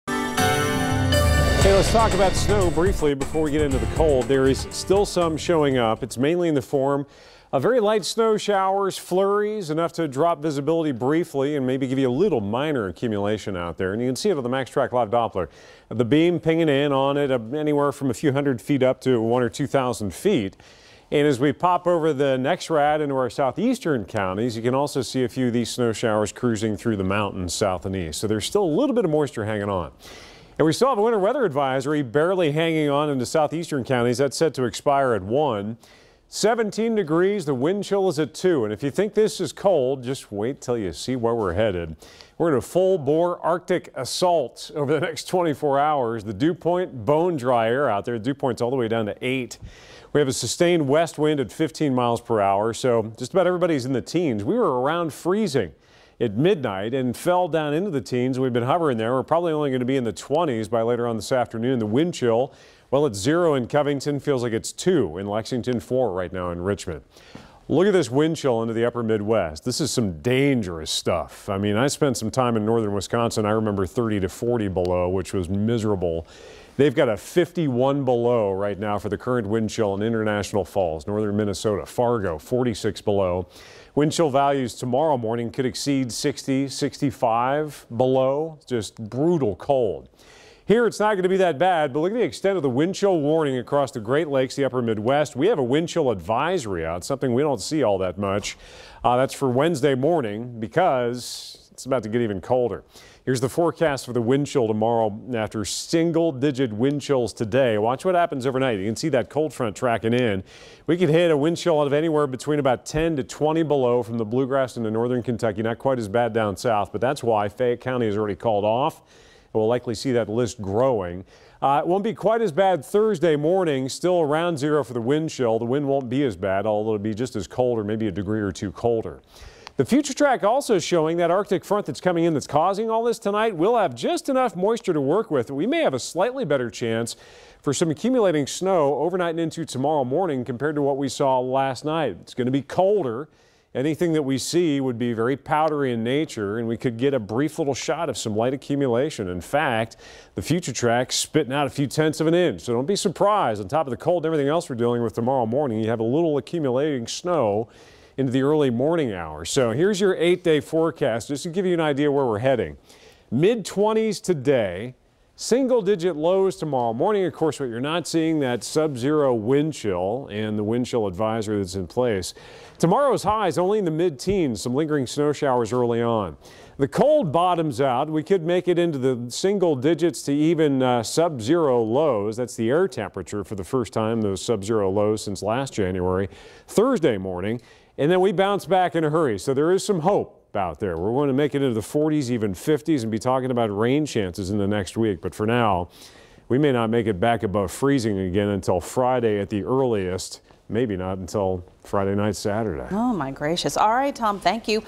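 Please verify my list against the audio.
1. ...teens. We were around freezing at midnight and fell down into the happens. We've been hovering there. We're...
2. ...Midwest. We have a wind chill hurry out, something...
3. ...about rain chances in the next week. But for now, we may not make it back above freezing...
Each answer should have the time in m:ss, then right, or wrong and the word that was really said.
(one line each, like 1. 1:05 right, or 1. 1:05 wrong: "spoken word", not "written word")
1. 0:54 wrong: "teens", not "happens"
2. 1:34 wrong: "advisory", not "hurry"
3. 3:13 right.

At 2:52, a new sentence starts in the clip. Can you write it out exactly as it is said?
Tomorrow's highs only in the mid teens, some lingering snow showers early on.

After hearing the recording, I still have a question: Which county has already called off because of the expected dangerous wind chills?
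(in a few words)
Fayette County.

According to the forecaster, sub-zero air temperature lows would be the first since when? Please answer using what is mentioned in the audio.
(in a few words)
last January.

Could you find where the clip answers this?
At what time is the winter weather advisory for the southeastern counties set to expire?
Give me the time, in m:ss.
0:35.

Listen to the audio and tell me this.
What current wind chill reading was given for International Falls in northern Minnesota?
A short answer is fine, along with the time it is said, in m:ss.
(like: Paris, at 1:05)
51 below, at 1:17.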